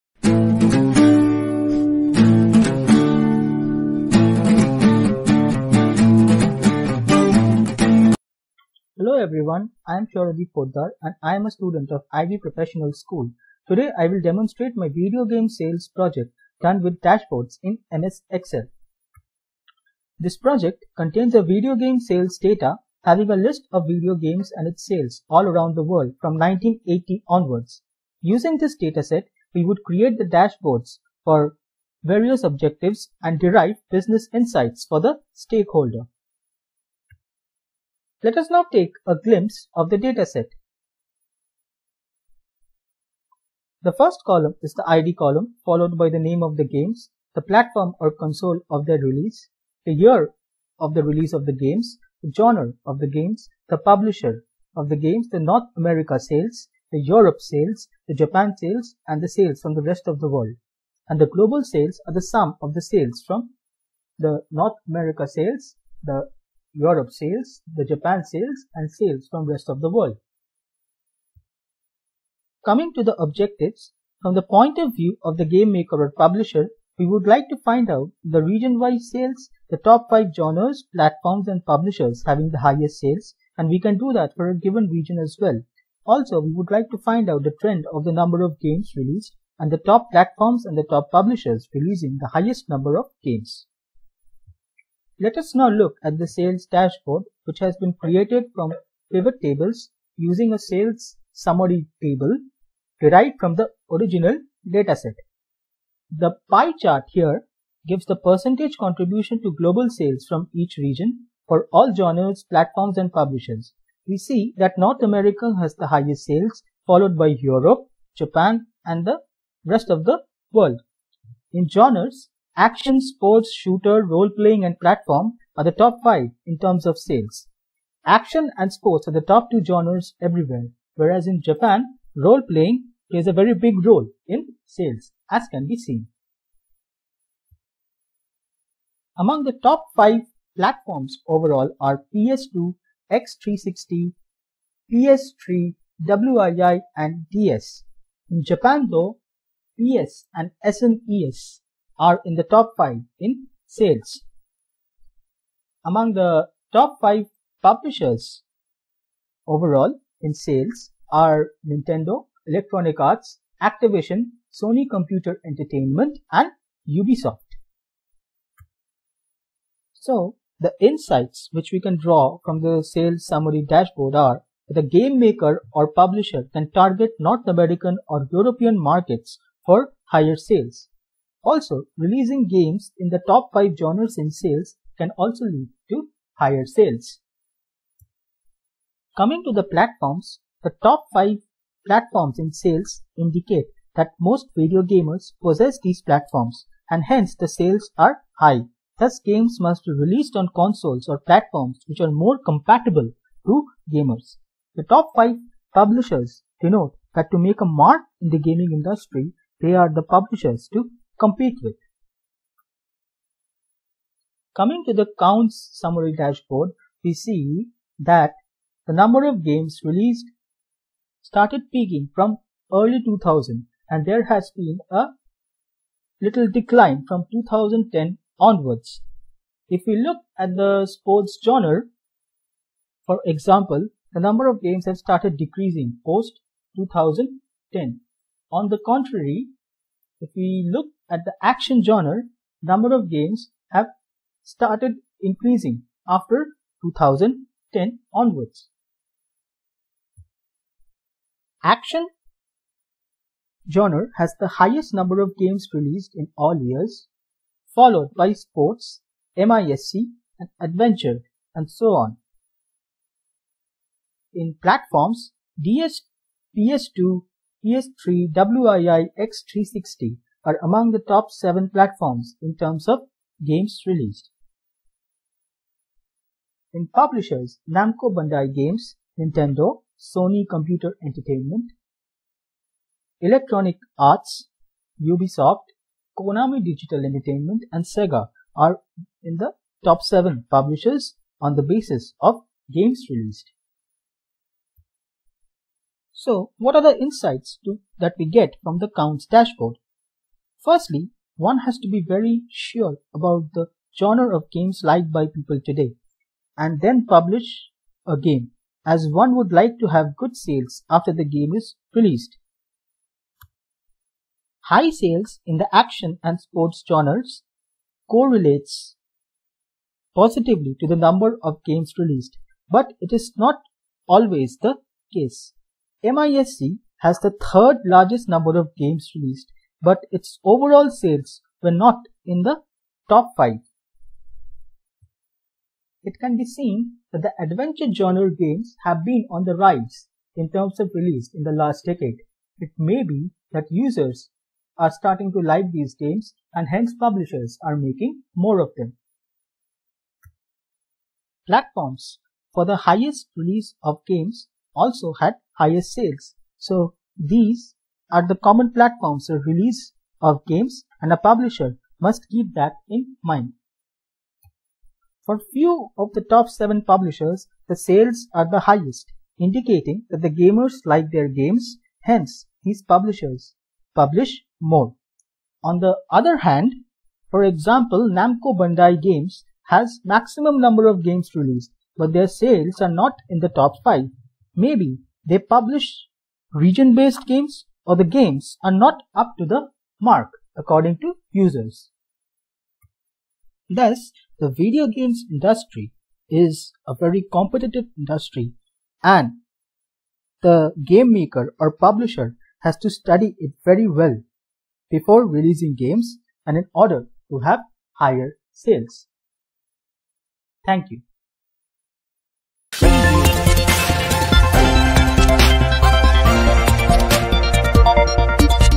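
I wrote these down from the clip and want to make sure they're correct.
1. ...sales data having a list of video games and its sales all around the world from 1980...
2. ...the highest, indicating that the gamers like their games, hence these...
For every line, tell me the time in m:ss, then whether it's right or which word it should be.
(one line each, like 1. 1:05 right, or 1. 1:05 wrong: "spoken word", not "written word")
1. 0:21 right
2. 6:08 right.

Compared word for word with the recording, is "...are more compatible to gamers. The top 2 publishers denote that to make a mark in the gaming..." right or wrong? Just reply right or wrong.
wrong.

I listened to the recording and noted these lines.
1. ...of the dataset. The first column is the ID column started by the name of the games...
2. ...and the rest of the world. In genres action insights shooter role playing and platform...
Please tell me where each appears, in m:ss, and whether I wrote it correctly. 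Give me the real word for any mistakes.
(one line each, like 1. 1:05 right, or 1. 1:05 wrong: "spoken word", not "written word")
1. 0:39 wrong: "followed", not "started"
2. 1:58 wrong: "sports", not "insights".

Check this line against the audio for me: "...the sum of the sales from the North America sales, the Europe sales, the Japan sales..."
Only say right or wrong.
right.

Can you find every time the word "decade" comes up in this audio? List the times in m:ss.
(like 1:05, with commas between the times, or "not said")
5:41.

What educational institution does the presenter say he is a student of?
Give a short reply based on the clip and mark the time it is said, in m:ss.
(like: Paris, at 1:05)
Ivy Professional School, at 0:12.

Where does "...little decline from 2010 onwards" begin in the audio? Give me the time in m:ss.
3:46.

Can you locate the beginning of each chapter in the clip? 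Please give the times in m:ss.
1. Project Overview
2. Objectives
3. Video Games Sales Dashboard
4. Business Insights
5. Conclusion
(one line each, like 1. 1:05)
1. 0:19
2. 1:11
3. 1:35
4. 2:49
5. 6:33.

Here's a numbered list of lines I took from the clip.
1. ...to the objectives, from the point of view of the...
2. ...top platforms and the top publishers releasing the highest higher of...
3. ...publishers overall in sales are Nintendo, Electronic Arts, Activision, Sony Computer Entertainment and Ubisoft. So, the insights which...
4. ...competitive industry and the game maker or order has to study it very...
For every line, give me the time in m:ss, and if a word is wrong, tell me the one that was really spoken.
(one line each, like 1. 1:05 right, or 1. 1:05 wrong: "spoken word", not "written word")
1. 1:12 right
2. 1:29 wrong: "number", not "higher"
3. 2:37 right
4. 6:37 wrong: "publisher", not "order".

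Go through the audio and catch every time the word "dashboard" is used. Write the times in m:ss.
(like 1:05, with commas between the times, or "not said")
0:17, 0:30, 1:36, 2:53, 3:36, 4:59.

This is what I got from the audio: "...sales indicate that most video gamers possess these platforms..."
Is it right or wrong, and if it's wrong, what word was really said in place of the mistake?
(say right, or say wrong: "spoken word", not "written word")
right.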